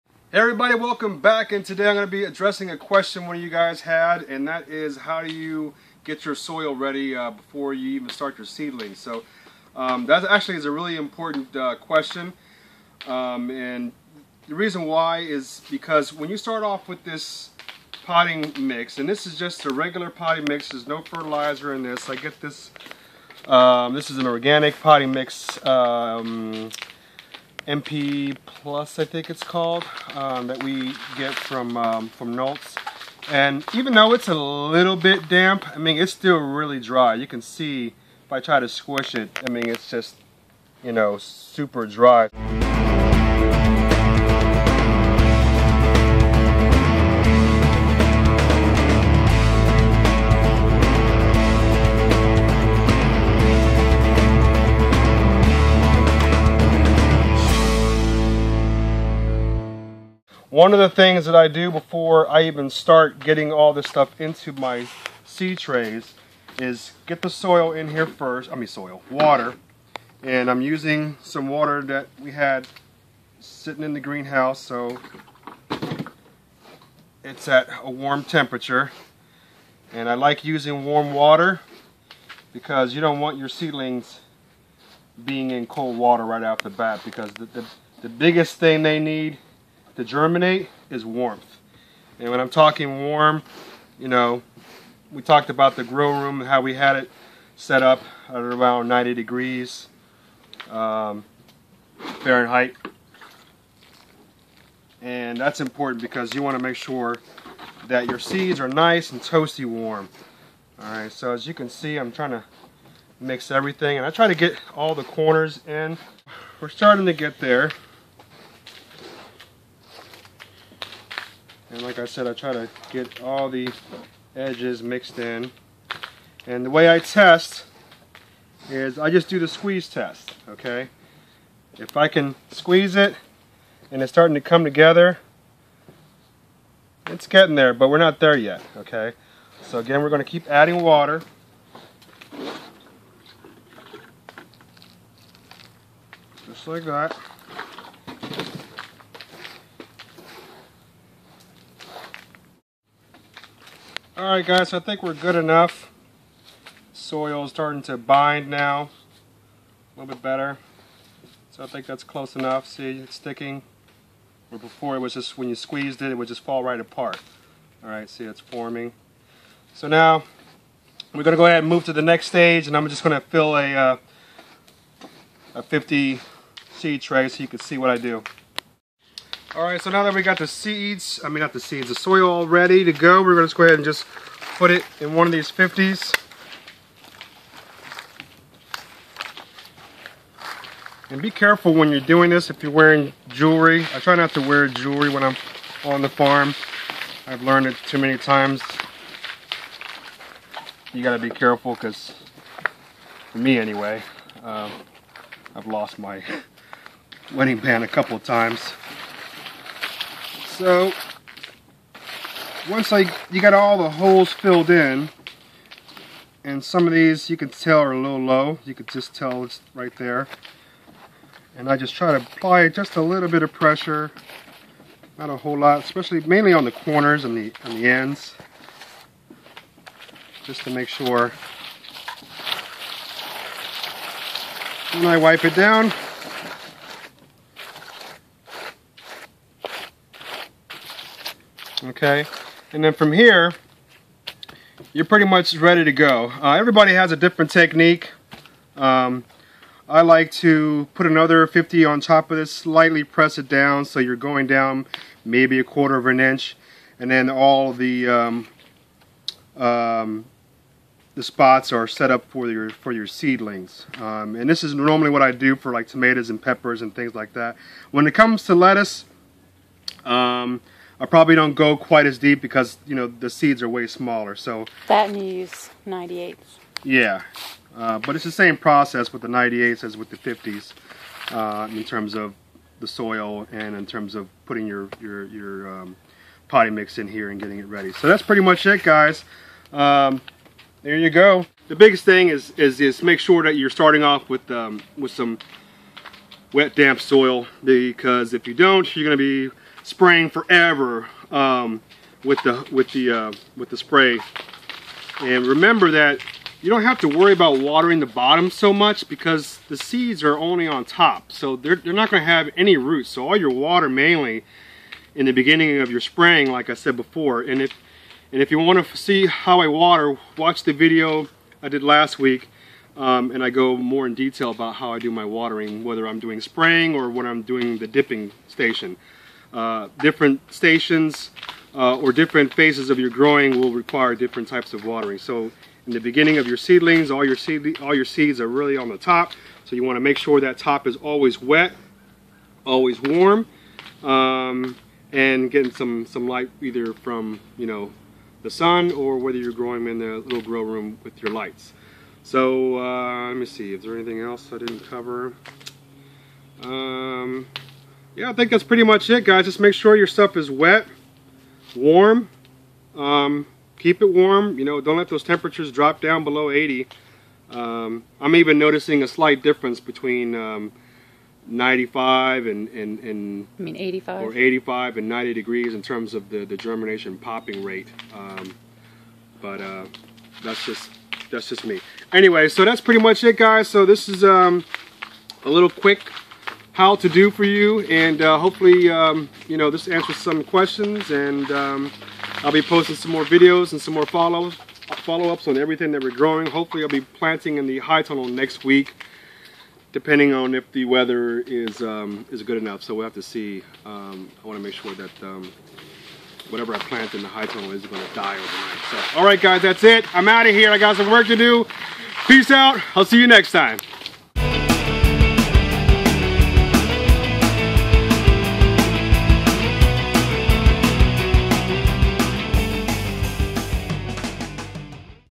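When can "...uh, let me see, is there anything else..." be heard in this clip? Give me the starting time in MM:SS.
05:52.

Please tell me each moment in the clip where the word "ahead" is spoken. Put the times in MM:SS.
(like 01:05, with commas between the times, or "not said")
02:51, 03:03.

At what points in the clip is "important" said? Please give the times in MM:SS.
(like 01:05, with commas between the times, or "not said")
00:10, 01:45.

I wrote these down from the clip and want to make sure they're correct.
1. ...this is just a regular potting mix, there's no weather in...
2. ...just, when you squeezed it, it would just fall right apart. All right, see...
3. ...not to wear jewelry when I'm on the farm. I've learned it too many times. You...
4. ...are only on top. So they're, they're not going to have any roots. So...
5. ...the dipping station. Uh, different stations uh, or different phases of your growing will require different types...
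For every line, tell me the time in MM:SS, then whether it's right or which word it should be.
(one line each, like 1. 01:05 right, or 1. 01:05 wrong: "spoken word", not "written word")
1. 00:19 wrong: "fertilizer", not "weather"
2. 02:45 right
3. 03:14 right
4. 05:10 right
5. 05:27 right.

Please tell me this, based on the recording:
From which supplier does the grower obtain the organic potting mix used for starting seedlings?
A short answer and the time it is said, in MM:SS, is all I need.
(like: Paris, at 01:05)
Nolts, at 00:32.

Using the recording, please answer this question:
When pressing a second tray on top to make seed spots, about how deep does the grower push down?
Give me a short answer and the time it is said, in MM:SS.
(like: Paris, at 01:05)
a quarter of an inch, at 04:15.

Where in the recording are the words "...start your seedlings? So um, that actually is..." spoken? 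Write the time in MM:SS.
00:08.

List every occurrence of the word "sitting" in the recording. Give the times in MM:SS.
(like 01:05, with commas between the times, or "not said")
01:13.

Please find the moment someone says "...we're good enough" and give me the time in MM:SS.
02:35.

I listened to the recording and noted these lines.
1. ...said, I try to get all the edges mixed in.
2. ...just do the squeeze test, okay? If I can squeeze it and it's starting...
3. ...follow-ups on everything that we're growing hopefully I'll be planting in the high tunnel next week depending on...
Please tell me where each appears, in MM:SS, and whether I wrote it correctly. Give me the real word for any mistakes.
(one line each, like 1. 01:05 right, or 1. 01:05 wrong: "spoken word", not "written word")
1. 02:02 right
2. 02:09 right
3. 06:35 right.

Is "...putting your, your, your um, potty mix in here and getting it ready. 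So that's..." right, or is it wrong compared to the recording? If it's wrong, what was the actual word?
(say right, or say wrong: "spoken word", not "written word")
right.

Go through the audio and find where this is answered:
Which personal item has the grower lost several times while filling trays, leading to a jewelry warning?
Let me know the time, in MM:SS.
03:27.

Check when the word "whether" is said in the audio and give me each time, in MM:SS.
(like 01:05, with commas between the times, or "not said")
05:25, 05:49.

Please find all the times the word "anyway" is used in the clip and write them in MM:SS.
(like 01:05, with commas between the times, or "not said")
03:23, 06:22.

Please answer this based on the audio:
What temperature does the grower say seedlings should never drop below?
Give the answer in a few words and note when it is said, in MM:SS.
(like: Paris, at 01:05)
80, at 06:06.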